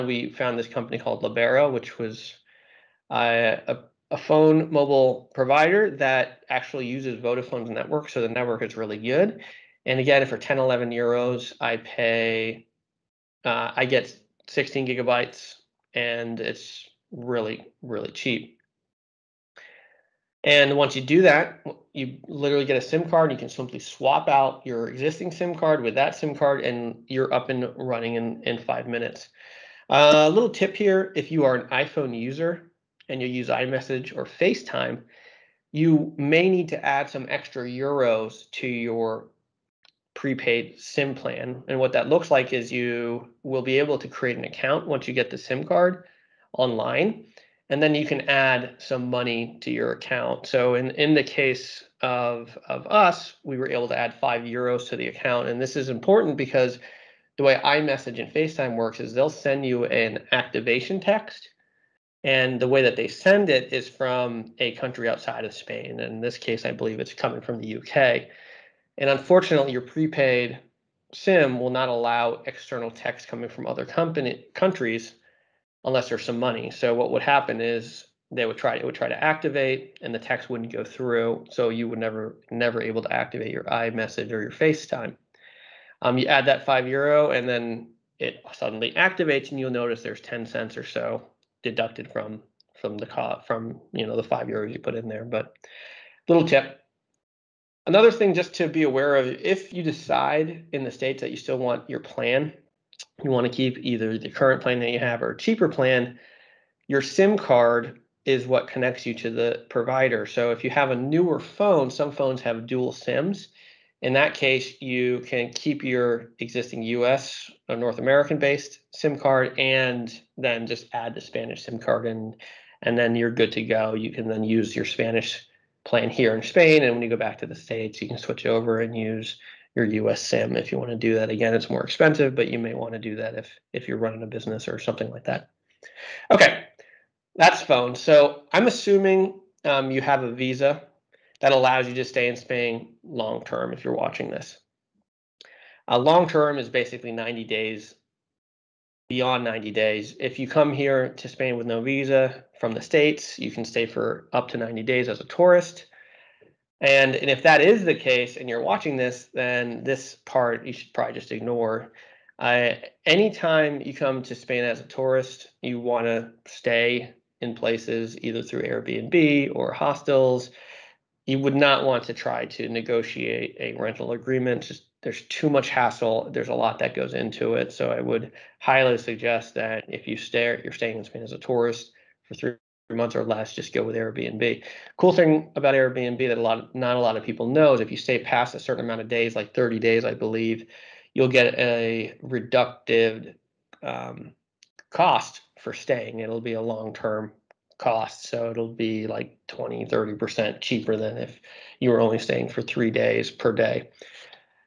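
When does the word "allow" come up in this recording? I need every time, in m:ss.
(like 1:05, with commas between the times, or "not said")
1:11, 2:21.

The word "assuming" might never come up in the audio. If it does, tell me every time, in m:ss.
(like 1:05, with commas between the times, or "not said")
2:18.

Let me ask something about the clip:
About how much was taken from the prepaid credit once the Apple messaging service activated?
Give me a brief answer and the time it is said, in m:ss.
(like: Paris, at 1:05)
10 cents, at 1:30.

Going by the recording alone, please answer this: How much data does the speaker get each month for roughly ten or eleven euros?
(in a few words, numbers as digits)
16 gigabytes.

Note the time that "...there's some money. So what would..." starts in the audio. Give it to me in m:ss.
1:16.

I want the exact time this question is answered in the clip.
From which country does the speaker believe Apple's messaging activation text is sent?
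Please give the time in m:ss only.
1:07.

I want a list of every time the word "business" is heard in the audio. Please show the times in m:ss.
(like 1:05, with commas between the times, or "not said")
2:14.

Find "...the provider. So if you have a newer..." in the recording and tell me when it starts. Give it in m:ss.
1:49.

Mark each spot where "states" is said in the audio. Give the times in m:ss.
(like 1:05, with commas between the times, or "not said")
1:40, 2:07, 2:32.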